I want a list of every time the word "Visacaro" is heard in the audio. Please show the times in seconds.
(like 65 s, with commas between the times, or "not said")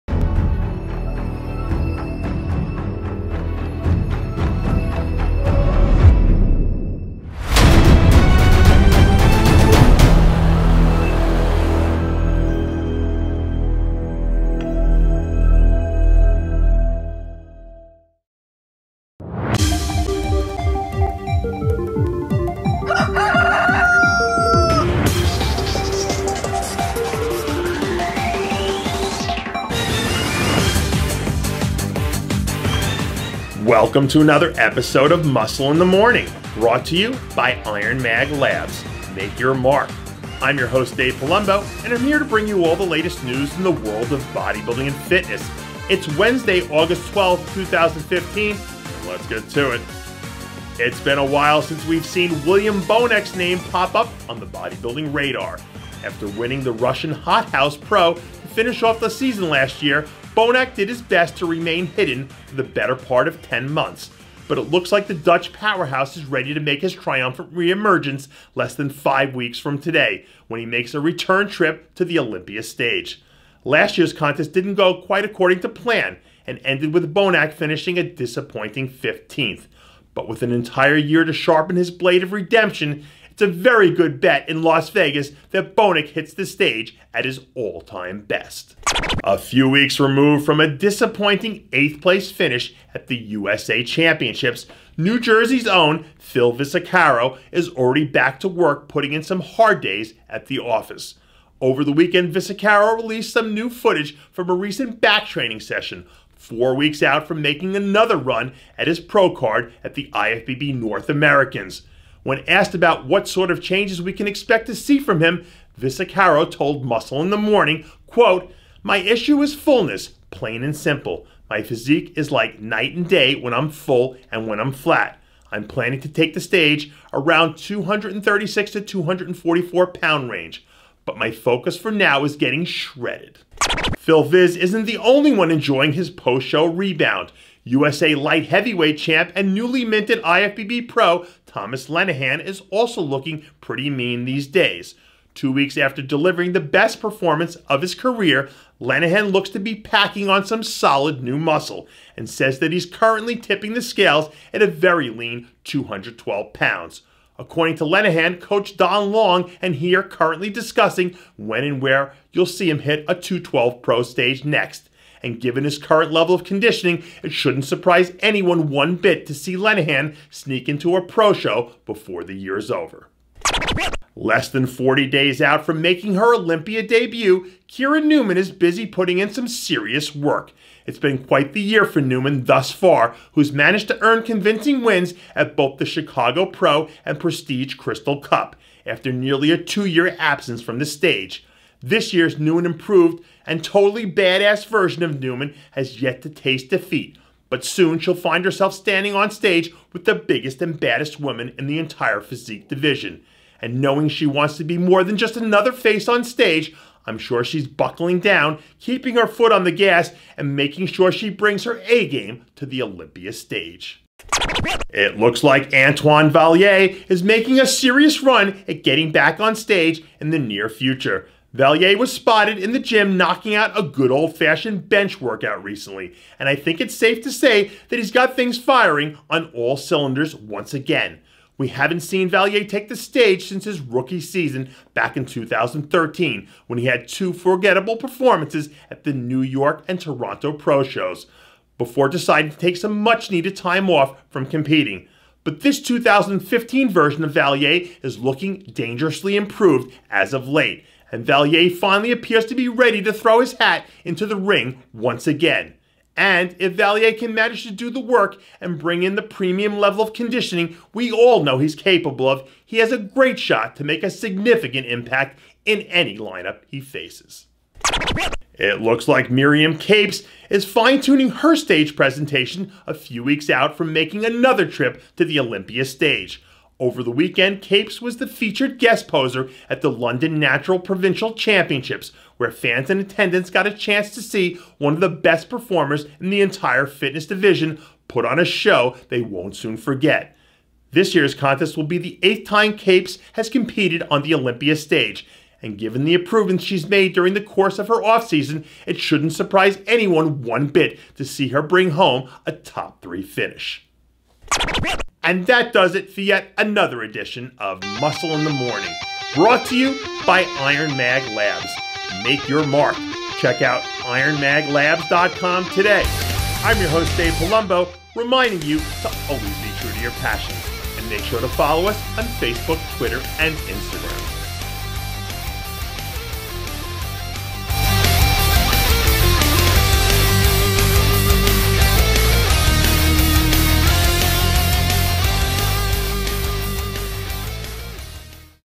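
96 s, 102 s.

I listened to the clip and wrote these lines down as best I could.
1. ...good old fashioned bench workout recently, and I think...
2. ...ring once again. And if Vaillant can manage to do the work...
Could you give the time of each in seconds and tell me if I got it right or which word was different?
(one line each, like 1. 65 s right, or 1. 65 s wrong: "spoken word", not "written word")
1. 223 s right
2. 254 s right.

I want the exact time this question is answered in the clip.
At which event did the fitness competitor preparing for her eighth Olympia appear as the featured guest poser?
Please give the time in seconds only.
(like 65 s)
279 s.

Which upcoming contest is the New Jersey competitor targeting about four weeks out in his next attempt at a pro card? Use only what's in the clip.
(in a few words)
IFBB North Americans.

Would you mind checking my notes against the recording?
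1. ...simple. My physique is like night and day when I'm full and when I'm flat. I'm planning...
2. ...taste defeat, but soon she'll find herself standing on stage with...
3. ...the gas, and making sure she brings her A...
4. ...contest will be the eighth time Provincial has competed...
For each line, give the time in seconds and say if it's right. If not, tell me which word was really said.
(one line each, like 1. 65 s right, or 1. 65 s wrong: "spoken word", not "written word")
1. 120 s right
2. 196 s right
3. 209 s right
4. 291 s wrong: "Capes", not "Provincial".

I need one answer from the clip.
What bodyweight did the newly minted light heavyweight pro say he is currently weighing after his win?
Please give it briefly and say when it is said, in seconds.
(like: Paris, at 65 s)
212 pounds, at 155 s.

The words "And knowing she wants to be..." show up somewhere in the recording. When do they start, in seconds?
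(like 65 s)
203 s.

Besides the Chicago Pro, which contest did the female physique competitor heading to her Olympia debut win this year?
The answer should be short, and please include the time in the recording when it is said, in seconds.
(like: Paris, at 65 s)
Prestige Crystal Cup, at 187 s.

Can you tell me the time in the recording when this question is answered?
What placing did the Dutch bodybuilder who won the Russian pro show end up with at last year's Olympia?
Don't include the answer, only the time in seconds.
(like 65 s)
78 s.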